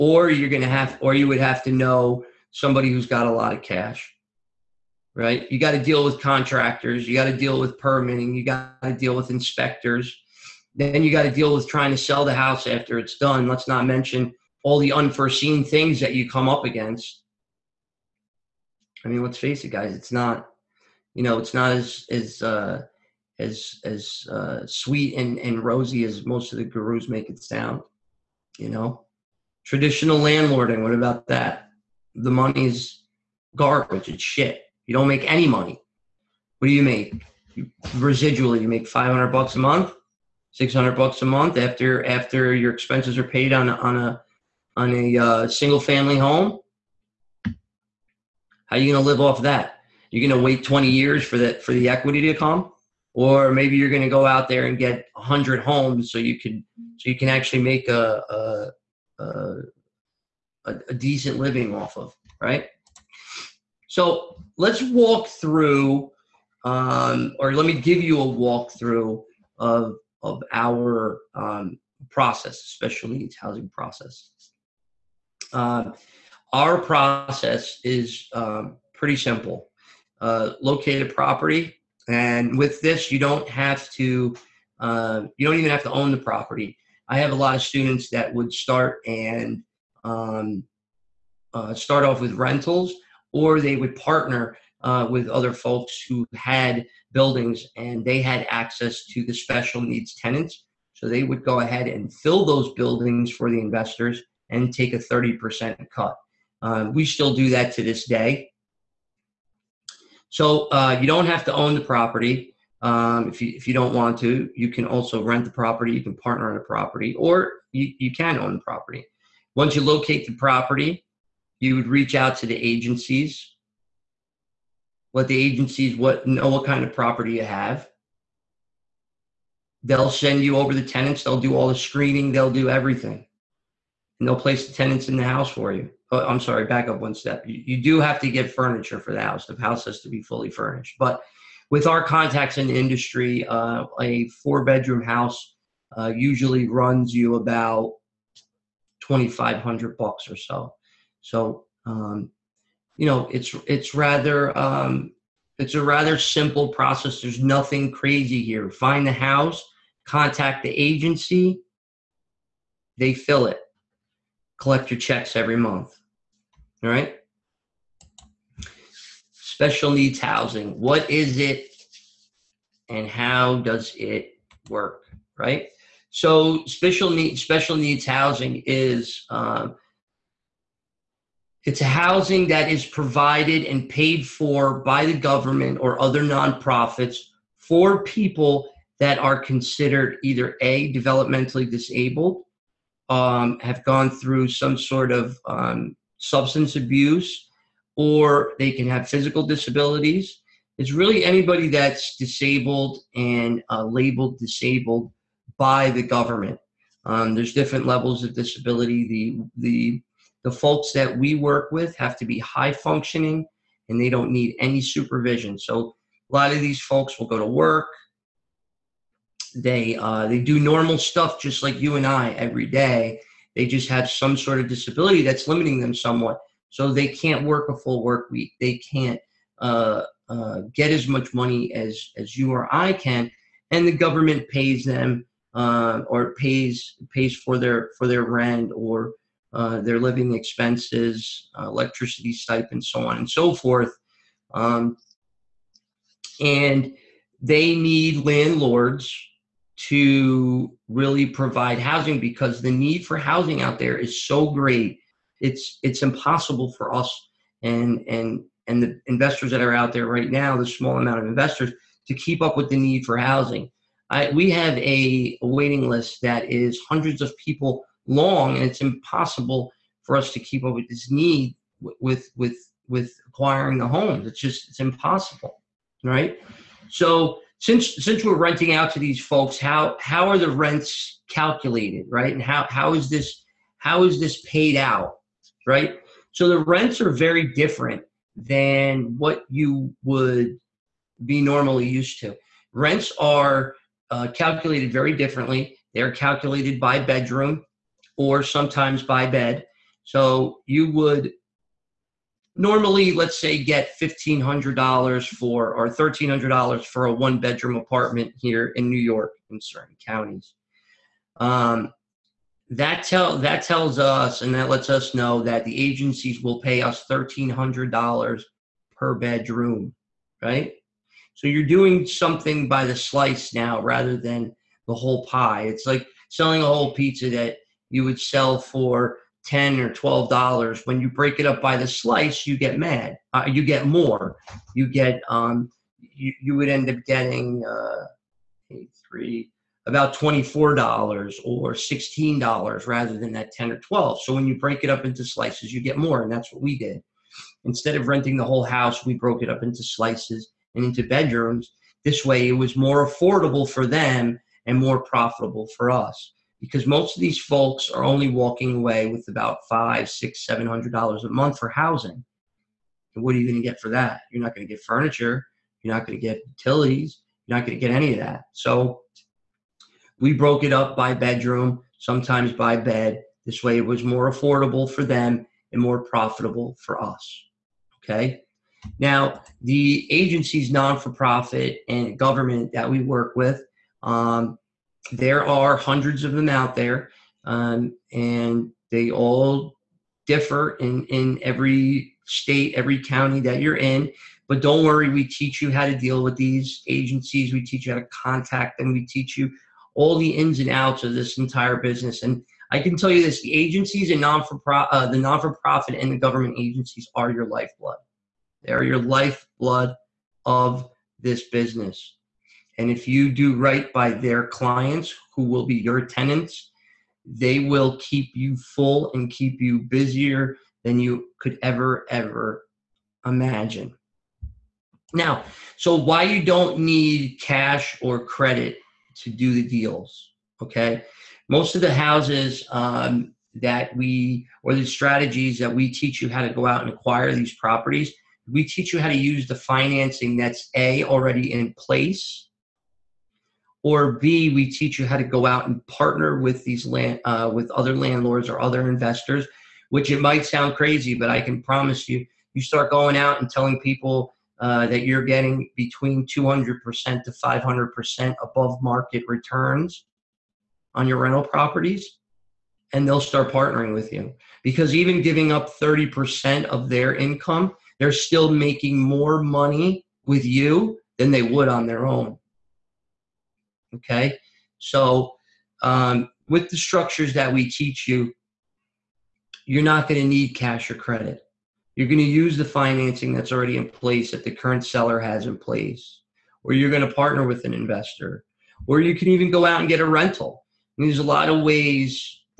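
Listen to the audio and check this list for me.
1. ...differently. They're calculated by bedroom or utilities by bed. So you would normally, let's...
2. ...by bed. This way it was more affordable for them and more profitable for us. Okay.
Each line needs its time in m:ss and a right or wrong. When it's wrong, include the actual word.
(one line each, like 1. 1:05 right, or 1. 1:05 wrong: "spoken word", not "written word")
1. 4:55 wrong: "sometimes", not "utilities"
2. 6:12 right.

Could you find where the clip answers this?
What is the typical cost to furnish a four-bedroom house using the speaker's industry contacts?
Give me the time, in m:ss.
2:29.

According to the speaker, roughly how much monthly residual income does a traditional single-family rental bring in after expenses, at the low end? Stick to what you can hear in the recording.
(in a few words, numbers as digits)
$500.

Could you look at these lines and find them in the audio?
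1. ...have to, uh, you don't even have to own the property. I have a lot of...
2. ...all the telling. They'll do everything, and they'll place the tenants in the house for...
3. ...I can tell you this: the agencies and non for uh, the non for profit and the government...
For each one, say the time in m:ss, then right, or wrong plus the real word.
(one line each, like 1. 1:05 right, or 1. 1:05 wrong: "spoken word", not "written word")
1. 1:23 right
2. 2:11 wrong: "screening", not "telling"
3. 6:42 right.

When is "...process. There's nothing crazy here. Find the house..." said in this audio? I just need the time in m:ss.
2:36.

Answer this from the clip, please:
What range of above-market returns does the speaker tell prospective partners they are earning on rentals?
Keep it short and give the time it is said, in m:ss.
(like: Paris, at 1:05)
200% to 500%, at 7:36.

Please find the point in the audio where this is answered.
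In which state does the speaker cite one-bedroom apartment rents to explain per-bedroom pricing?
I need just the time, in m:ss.
5:08.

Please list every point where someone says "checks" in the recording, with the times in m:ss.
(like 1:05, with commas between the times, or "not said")
2:44.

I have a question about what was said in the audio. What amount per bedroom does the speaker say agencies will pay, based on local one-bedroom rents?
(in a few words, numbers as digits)
$1,300.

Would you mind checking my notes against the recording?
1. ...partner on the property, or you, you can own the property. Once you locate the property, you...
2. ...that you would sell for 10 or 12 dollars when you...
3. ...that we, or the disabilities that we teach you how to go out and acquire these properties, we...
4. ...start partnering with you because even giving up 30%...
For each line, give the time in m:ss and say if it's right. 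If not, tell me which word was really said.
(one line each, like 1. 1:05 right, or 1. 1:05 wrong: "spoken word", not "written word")
1. 1:56 right
2. 5:27 right
3. 7:13 wrong: "strategies", not "disabilities"
4. 7:43 right.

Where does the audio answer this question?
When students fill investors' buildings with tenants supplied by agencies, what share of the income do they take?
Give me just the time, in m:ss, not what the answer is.
1:44.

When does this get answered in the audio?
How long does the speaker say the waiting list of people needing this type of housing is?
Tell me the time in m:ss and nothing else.
4:26.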